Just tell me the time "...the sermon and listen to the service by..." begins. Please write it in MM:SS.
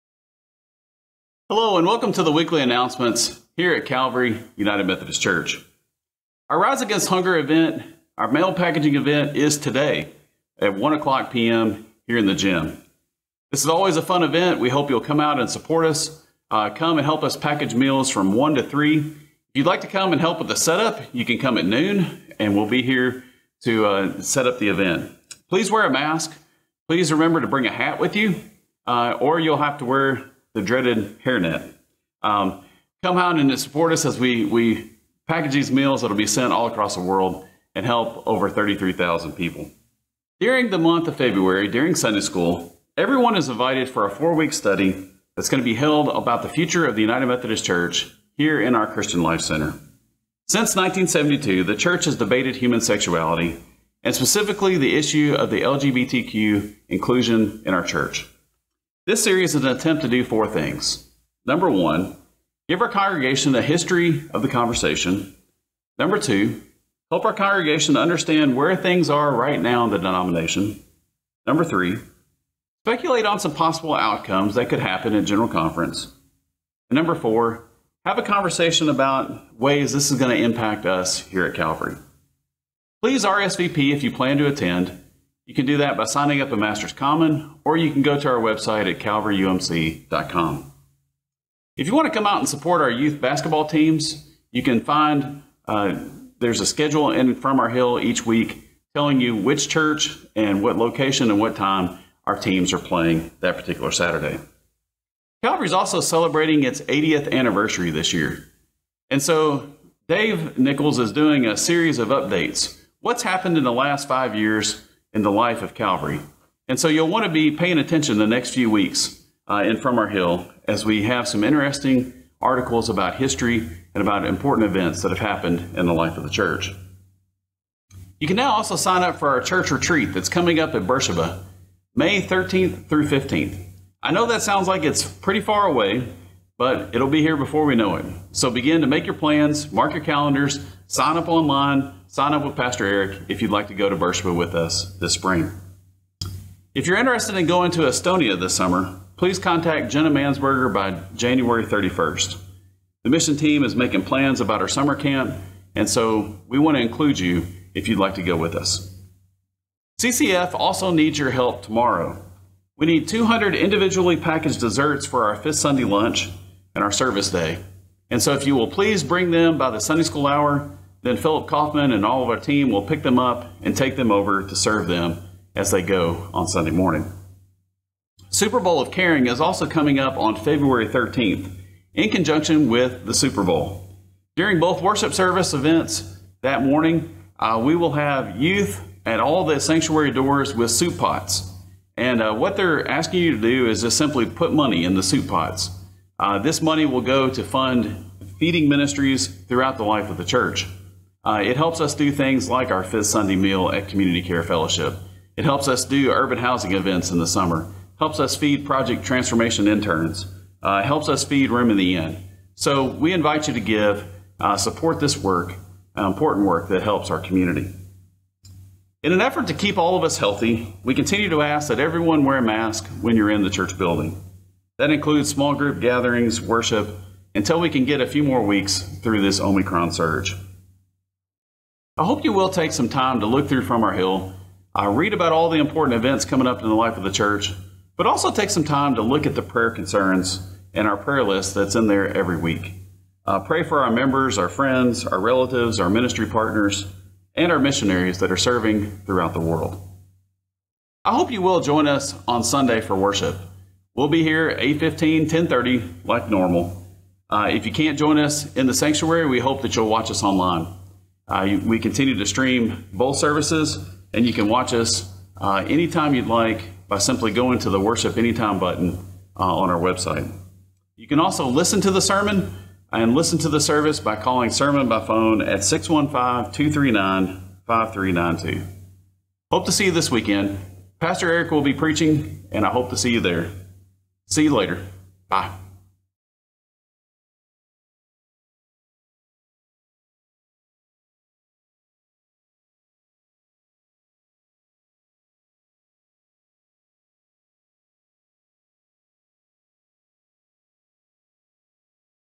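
04:31.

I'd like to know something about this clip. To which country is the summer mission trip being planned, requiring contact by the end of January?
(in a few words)
Estonia.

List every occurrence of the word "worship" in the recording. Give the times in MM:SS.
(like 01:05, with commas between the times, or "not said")
03:04, 03:46, 04:12, 04:27.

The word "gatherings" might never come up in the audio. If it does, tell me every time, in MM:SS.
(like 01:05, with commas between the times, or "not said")
03:45.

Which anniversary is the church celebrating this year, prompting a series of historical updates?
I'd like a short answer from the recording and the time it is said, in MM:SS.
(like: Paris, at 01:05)
80th, at 01:46.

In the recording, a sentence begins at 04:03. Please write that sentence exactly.
Uh, pray for our members, our friends, our relatives, our ministry partners, and our missionaries that are serving throughout the world.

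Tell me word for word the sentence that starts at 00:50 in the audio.
Since 1972, the church has debated human sexuality and specifically the issue of the LGBTQ inclusion in our church.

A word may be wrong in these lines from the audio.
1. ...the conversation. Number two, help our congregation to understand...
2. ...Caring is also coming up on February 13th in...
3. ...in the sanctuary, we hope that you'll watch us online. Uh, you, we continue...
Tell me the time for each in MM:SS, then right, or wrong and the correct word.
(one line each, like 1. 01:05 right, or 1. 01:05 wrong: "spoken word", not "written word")
1. 01:04 right
2. 02:58 right
3. 04:18 right.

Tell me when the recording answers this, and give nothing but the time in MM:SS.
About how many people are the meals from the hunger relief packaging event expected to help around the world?
00:38.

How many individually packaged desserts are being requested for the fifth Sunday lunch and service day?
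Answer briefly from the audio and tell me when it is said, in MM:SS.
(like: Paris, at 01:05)
200, at 02:43.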